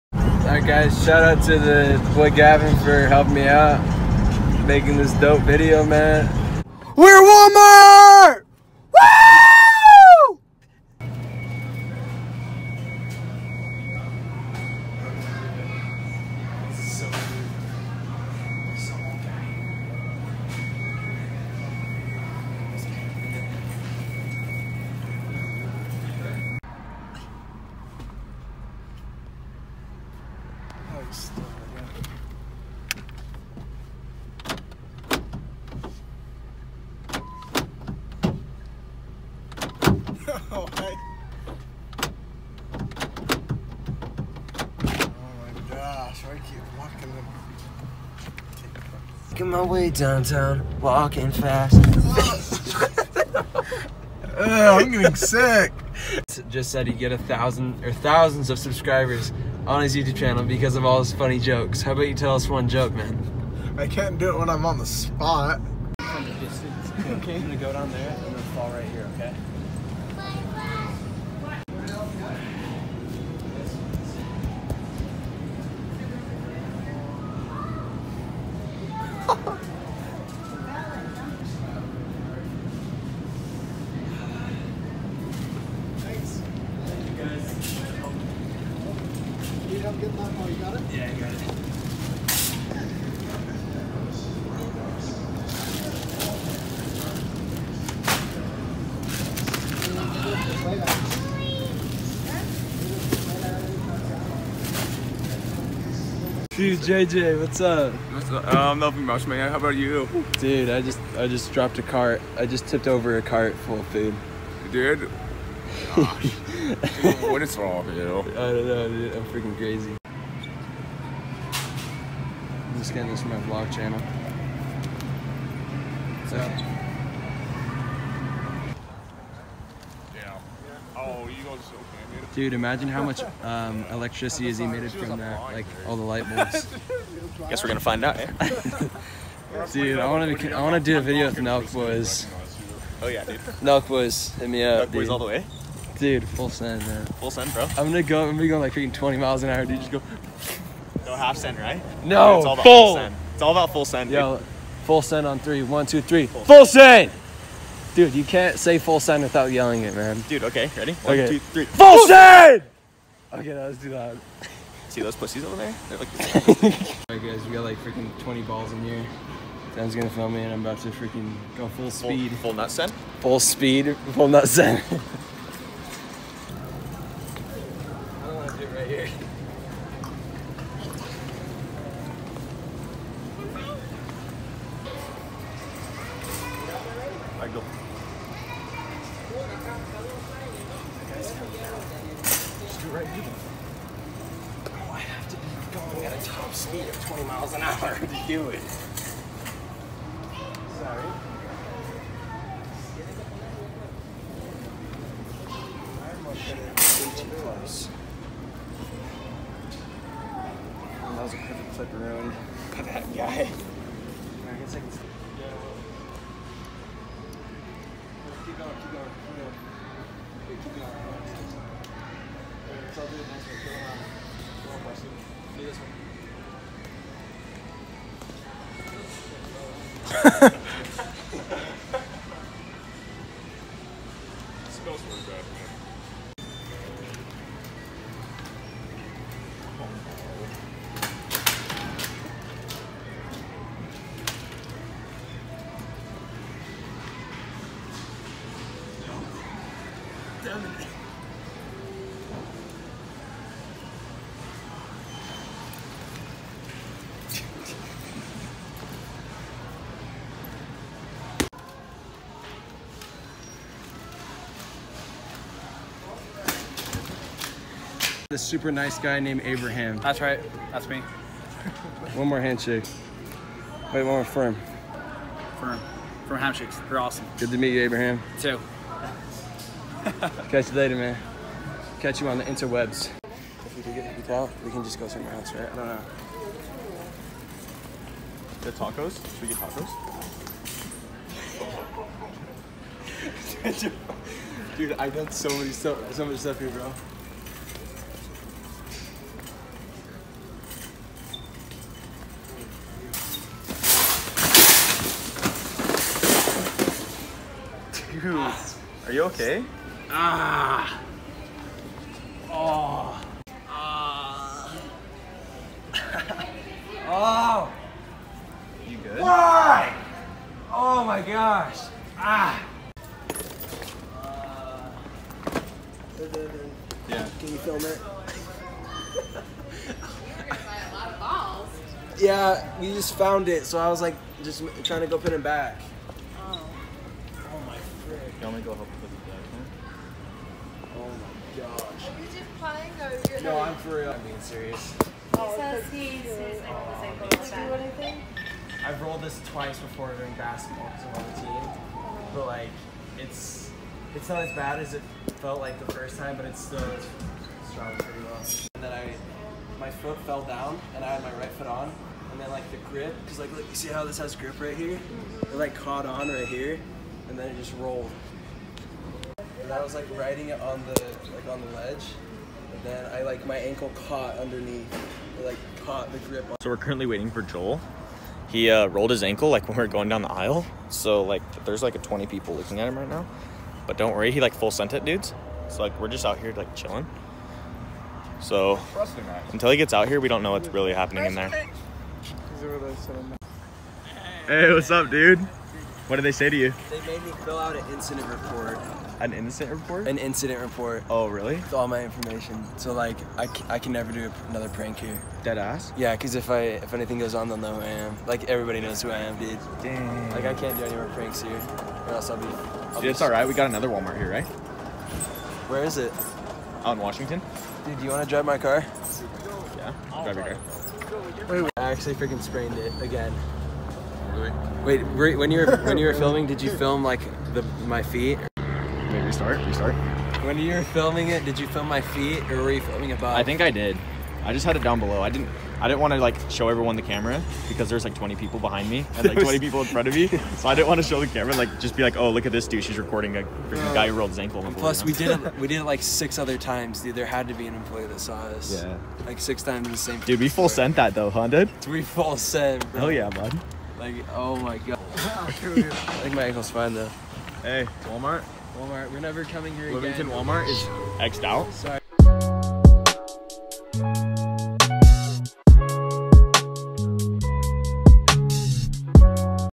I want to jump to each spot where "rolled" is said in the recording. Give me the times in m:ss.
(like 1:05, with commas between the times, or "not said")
5:49, 6:07, 6:18, 7:24.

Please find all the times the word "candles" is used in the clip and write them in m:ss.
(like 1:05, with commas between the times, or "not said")
not said.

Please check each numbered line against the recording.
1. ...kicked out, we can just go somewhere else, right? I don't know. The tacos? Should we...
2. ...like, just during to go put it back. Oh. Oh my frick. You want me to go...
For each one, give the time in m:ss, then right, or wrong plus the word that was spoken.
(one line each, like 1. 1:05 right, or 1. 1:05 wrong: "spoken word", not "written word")
1. 4:44 right
2. 5:34 wrong: "trying", not "during".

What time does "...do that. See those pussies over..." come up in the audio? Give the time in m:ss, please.
2:43.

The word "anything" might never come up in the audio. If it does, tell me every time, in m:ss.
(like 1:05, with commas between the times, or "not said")
5:47, 6:46.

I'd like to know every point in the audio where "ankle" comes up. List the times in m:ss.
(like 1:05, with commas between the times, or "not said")
6:13, 6:19, 7:24, 7:36.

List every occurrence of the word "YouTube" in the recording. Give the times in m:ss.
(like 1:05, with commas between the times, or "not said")
0:59.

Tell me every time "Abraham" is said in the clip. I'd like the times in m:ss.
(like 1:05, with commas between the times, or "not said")
4:29, 4:37.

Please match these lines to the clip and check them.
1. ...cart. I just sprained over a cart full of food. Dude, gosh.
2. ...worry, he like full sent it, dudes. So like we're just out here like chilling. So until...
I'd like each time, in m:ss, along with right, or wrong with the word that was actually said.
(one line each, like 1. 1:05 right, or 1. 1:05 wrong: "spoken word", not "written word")
1. 1:51 wrong: "tipped", not "sprained"
2. 6:24 right.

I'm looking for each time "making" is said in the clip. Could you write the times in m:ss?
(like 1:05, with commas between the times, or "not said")
0:04, 0:49.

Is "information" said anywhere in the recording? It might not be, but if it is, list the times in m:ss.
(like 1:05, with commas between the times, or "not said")
6:42.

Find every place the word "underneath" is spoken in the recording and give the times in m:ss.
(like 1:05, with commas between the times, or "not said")
6:14.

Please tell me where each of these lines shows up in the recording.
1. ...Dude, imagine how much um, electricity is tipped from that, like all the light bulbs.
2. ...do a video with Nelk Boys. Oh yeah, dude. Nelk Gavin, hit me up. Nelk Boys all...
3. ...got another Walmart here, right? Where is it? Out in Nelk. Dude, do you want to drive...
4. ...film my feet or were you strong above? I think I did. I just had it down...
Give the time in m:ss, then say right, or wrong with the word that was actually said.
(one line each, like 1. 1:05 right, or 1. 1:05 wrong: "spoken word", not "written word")
1. 2:12 wrong: "emitted", not "tipped"
2. 2:20 wrong: "Boys", not "Gavin"
3. 6:53 wrong: "Washington", not "Nelk"
4. 7:11 wrong: "filming", not "strong".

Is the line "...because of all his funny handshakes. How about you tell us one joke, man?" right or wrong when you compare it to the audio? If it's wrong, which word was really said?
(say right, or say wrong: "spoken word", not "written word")
wrong: "jokes", not "handshakes".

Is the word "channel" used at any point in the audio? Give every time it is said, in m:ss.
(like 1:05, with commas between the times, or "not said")
1:00, 2:03.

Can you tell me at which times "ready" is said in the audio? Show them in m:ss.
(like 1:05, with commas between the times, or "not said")
2:40.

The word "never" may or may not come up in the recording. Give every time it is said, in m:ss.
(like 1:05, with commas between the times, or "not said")
6:43, 7:39.